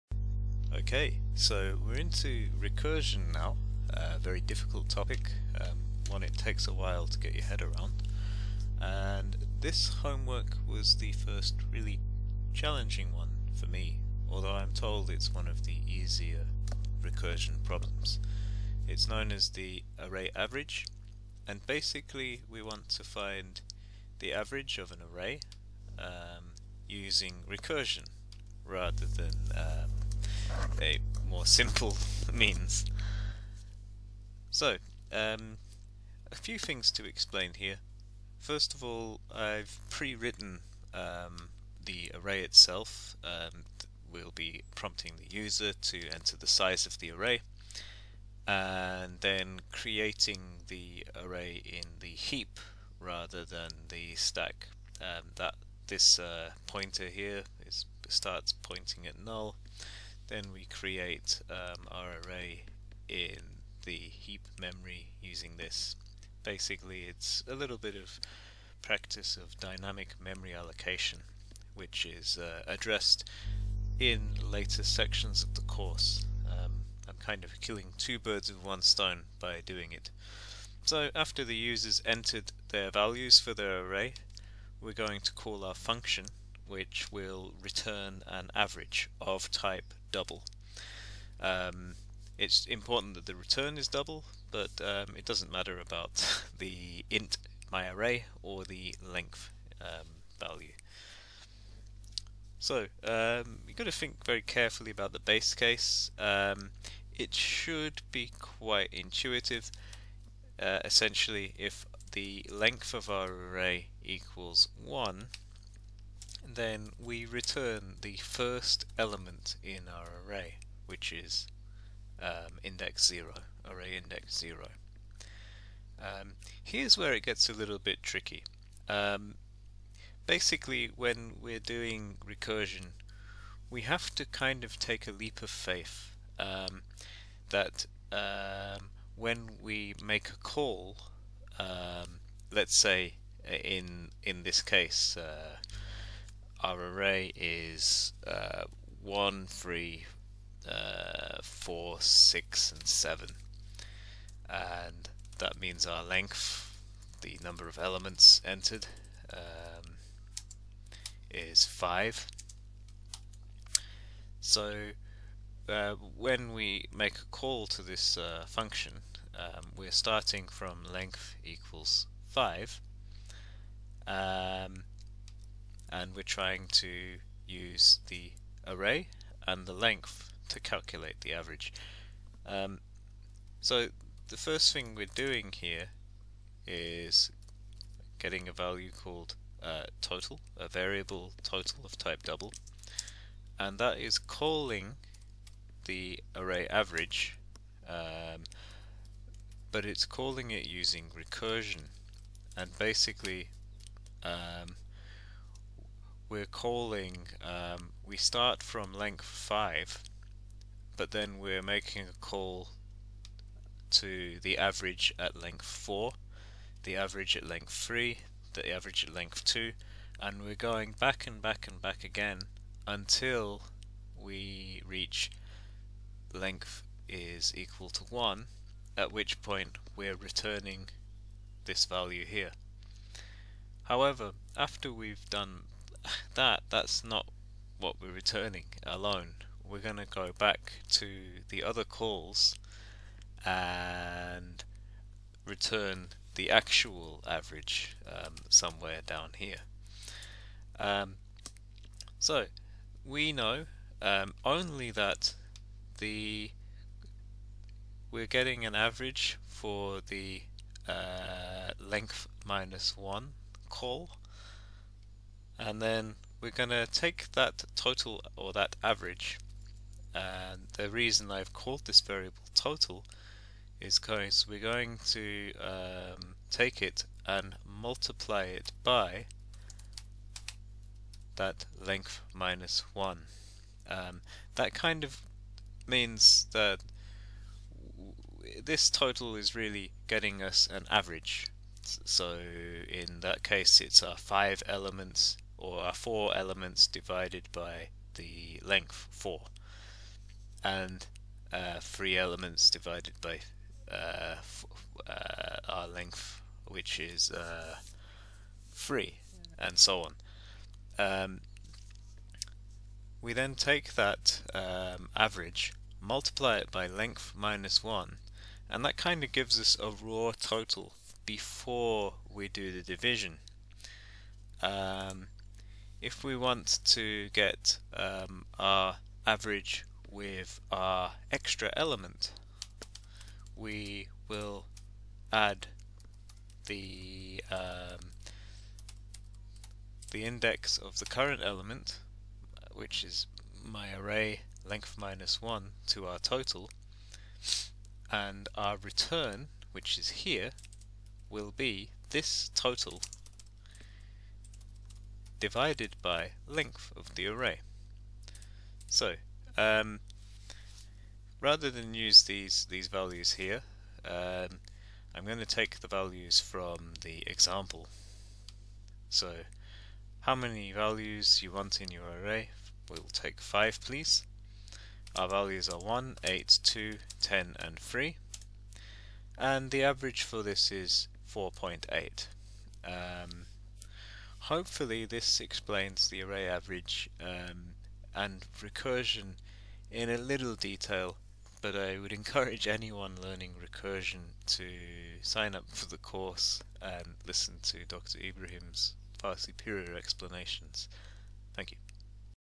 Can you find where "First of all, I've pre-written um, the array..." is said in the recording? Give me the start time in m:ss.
0:38.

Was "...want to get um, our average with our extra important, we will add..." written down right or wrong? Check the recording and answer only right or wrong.
wrong.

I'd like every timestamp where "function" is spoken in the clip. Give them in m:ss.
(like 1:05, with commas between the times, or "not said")
1:25, 2:48.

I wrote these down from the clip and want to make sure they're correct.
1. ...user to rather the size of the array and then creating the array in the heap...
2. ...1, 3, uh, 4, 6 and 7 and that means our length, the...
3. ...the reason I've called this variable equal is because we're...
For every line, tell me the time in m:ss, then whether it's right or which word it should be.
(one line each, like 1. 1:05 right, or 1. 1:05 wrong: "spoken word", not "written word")
1. 0:45 wrong: "enter", not "rather"
2. 2:29 right
3. 4:30 wrong: "total", not "equal".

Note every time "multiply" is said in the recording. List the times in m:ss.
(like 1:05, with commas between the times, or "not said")
4:37, 5:16.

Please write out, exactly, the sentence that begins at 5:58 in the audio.
So, um, rather than use these, these values here, um, I'm going to take the values from the example.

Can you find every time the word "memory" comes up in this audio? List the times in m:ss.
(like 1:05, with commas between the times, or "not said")
1:04, 1:10.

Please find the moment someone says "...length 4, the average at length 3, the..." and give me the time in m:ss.
3:35.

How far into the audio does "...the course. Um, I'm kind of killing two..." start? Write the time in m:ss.
1:15.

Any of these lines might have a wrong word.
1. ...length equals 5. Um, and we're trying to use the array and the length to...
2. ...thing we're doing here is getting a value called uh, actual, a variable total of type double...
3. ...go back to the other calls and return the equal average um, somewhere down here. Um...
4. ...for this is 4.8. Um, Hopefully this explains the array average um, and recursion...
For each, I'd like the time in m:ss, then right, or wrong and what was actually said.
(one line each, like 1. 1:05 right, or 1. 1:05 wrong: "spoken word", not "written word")
1. 2:50 right
2. 3:04 wrong: "total", not "actual"
3. 4:00 wrong: "actual", not "equal"
4. 6:20 right.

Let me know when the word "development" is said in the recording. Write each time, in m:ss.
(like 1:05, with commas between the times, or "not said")
not said.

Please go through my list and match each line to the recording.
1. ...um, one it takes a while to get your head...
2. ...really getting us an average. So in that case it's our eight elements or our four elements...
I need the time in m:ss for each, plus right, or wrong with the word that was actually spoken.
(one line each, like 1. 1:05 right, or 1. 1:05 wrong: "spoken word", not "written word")
1. 0:05 right
2. 4:49 wrong: "five", not "eight".